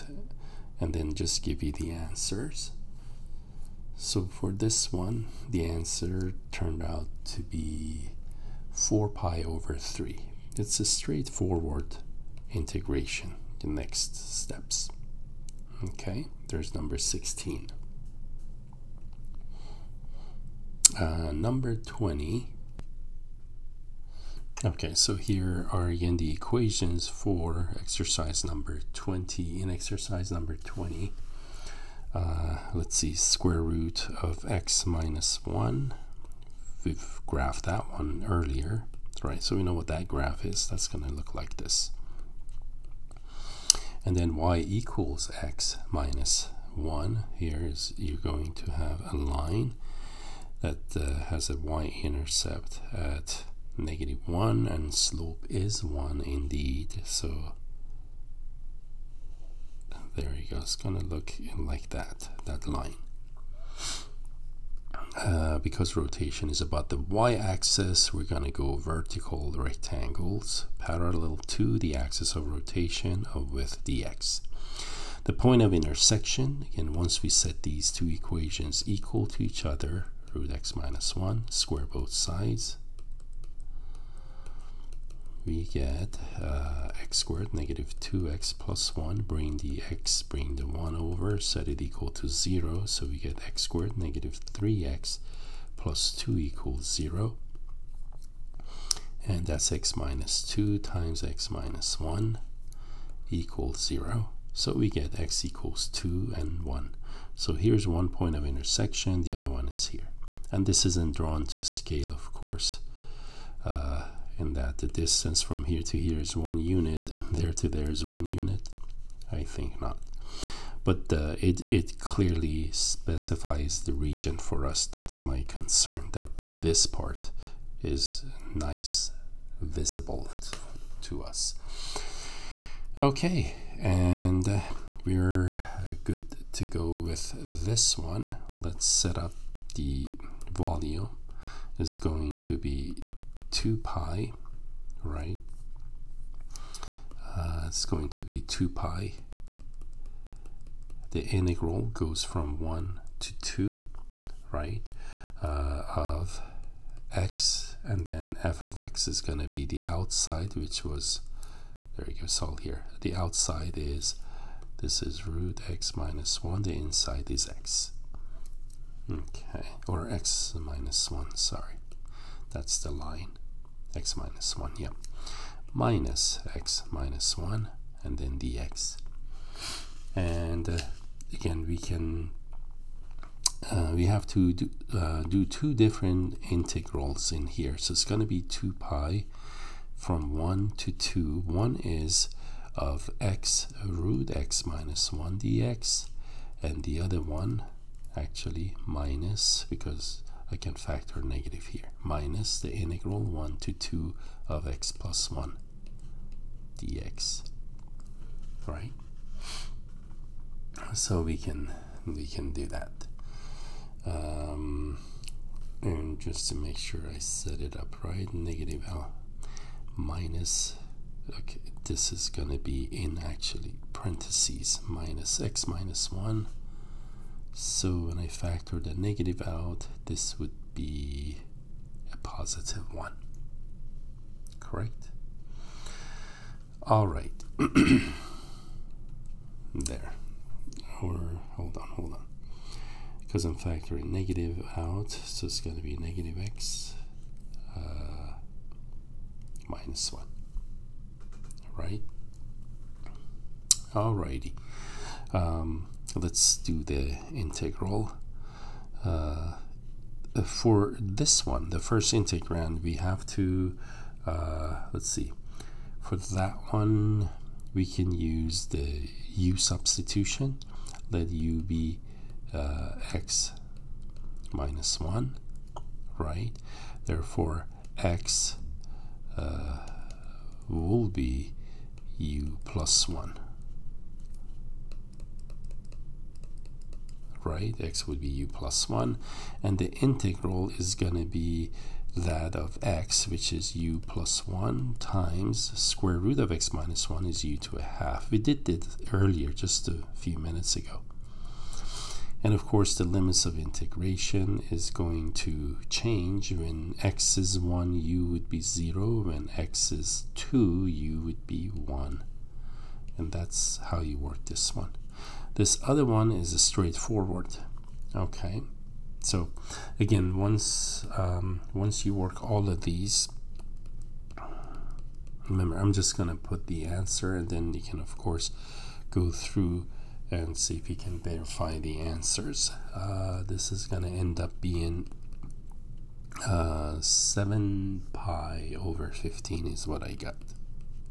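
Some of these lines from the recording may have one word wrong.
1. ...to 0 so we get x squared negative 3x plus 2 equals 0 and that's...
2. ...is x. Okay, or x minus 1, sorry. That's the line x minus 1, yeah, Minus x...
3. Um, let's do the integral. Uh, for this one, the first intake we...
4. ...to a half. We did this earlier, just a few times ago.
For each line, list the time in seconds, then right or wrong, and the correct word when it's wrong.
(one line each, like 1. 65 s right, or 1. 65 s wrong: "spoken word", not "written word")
1. 92 s right
2. 167 s right
3. 255 s right
4. 297 s wrong: "minutes", not "times".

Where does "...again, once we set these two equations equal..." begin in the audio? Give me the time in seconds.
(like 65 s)
76 s.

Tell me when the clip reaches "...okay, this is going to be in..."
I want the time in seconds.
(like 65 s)
221 s.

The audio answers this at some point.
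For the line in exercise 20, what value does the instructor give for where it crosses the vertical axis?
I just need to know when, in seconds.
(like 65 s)
53 s.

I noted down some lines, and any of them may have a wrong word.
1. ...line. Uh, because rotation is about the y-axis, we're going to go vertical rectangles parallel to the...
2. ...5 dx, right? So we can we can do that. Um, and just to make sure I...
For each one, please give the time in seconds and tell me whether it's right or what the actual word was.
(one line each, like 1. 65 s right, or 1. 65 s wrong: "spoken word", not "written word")
1. 62 s right
2. 205 s wrong: "1", not "5".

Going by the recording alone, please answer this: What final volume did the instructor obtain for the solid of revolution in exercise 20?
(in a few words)
7π/15.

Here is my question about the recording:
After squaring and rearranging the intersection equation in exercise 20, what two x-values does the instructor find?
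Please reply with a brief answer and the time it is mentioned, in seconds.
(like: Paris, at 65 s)
2 and 1, at 105 s.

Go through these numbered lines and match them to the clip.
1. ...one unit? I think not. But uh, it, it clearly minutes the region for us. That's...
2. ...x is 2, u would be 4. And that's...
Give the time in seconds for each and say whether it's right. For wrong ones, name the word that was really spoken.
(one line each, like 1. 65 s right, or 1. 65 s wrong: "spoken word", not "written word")
1. 118 s wrong: "specifies", not "minutes"
2. 309 s wrong: "1", not "4".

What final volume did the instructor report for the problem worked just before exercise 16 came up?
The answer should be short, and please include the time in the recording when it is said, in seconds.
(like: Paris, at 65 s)
4π/3, at 8 s.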